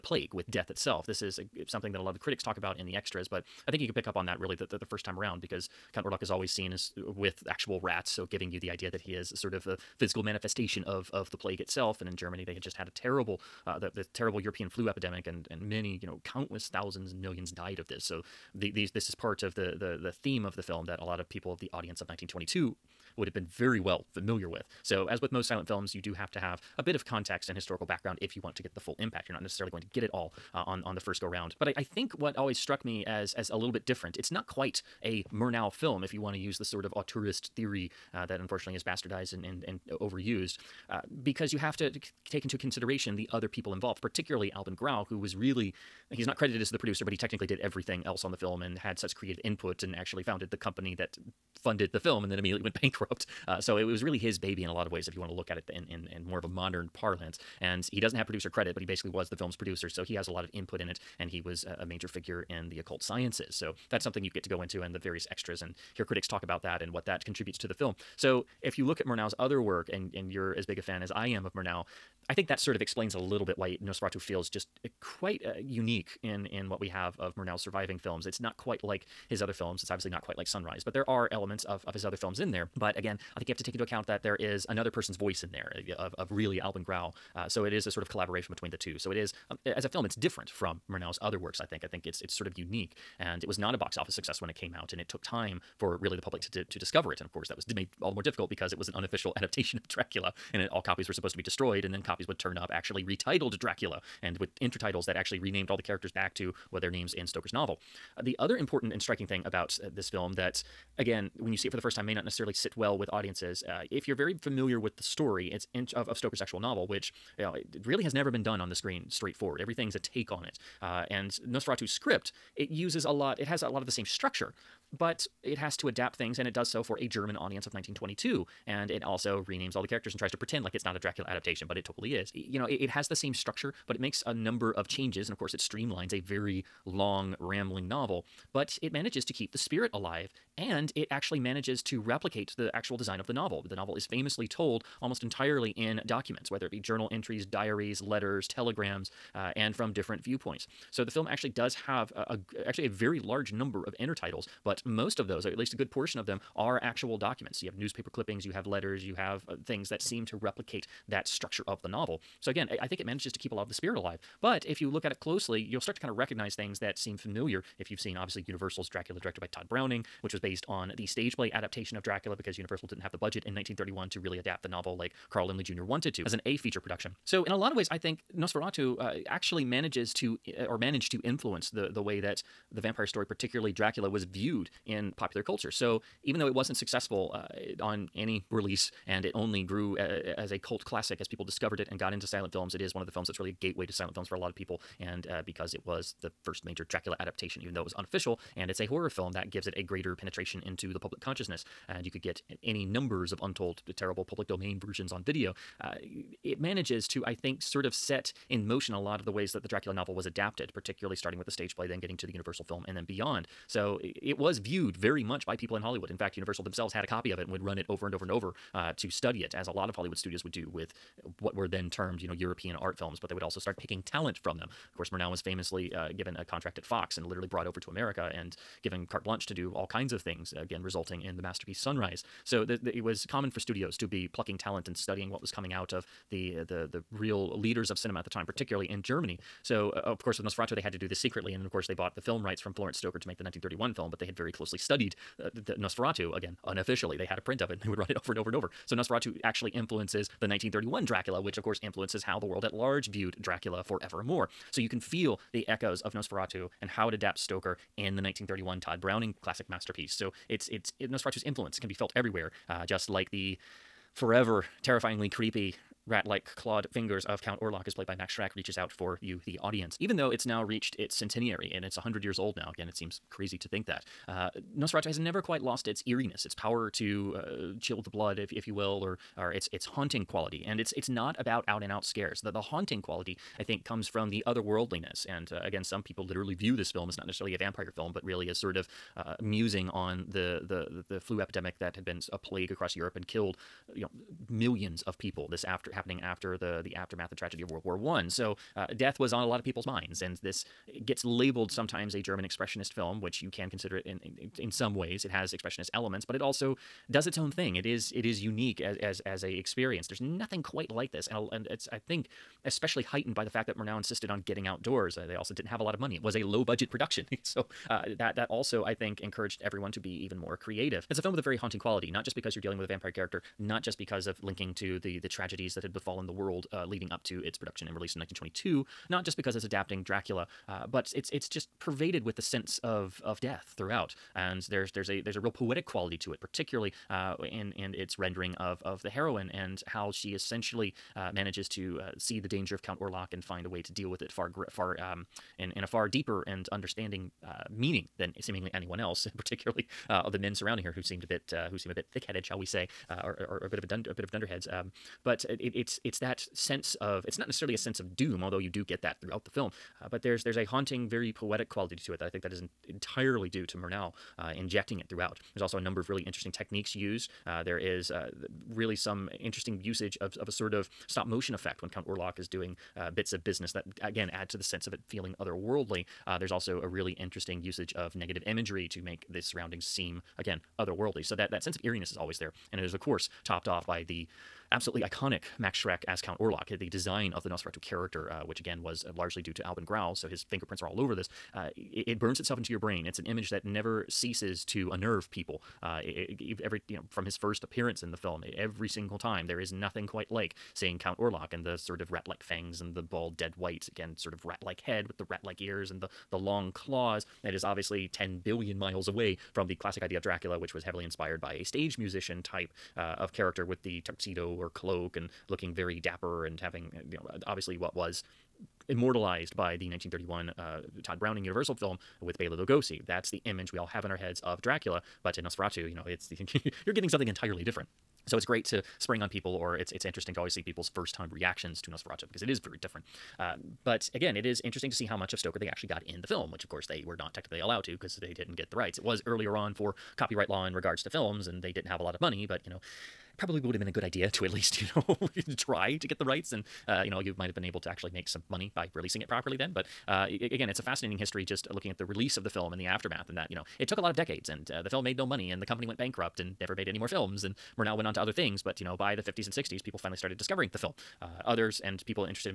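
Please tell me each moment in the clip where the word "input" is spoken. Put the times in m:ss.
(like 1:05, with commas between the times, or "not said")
0:49, 1:00.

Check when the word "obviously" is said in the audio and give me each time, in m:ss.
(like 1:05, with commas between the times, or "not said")
1:19, 2:48, 6:47, 6:57.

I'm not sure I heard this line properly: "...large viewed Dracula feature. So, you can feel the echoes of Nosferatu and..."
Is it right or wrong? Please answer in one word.
wrong.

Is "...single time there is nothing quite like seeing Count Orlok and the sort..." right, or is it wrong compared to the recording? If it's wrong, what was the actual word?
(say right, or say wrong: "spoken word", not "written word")
right.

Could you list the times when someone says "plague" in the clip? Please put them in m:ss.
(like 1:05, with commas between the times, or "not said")
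0:11, 4:52.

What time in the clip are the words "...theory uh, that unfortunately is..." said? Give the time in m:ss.
0:37.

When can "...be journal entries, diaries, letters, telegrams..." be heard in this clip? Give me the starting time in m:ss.
2:26.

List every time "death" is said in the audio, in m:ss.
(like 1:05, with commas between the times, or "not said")
0:00, 4:58, 5:33.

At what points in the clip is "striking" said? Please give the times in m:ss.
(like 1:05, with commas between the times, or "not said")
1:49.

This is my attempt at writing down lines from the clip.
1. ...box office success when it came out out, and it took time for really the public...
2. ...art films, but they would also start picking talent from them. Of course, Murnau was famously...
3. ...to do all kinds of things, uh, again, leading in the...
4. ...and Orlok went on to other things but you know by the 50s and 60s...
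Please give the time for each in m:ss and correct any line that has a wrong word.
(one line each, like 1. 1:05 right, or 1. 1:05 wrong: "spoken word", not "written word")
1. 1:33 right
2. 3:42 right
3. 3:49 wrong: "resulting", not "leading"
4. 7:37 wrong: "Murnau", not "Orlok".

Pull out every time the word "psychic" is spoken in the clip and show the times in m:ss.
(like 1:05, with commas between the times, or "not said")
not said.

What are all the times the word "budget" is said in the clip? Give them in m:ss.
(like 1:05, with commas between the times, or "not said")
2:53, 5:16.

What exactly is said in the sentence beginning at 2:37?
You have newspaper clippings, you have letters, you have uh, things that seem to replicate that structure of the novel.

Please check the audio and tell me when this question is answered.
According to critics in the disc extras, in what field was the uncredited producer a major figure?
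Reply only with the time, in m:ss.
1:02.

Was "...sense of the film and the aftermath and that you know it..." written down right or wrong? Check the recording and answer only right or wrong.
wrong.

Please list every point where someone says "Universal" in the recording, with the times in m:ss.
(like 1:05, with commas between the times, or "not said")
2:48, 2:52, 3:32, 3:36, 7:01.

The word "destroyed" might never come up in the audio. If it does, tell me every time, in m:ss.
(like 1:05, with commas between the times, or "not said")
1:41.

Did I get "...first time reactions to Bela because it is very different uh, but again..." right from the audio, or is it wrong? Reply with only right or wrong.
wrong.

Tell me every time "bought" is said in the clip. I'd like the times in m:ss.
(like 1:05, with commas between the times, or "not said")
4:01.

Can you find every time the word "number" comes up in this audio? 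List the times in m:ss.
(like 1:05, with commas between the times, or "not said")
2:14, 2:33, 3:22, 6:05.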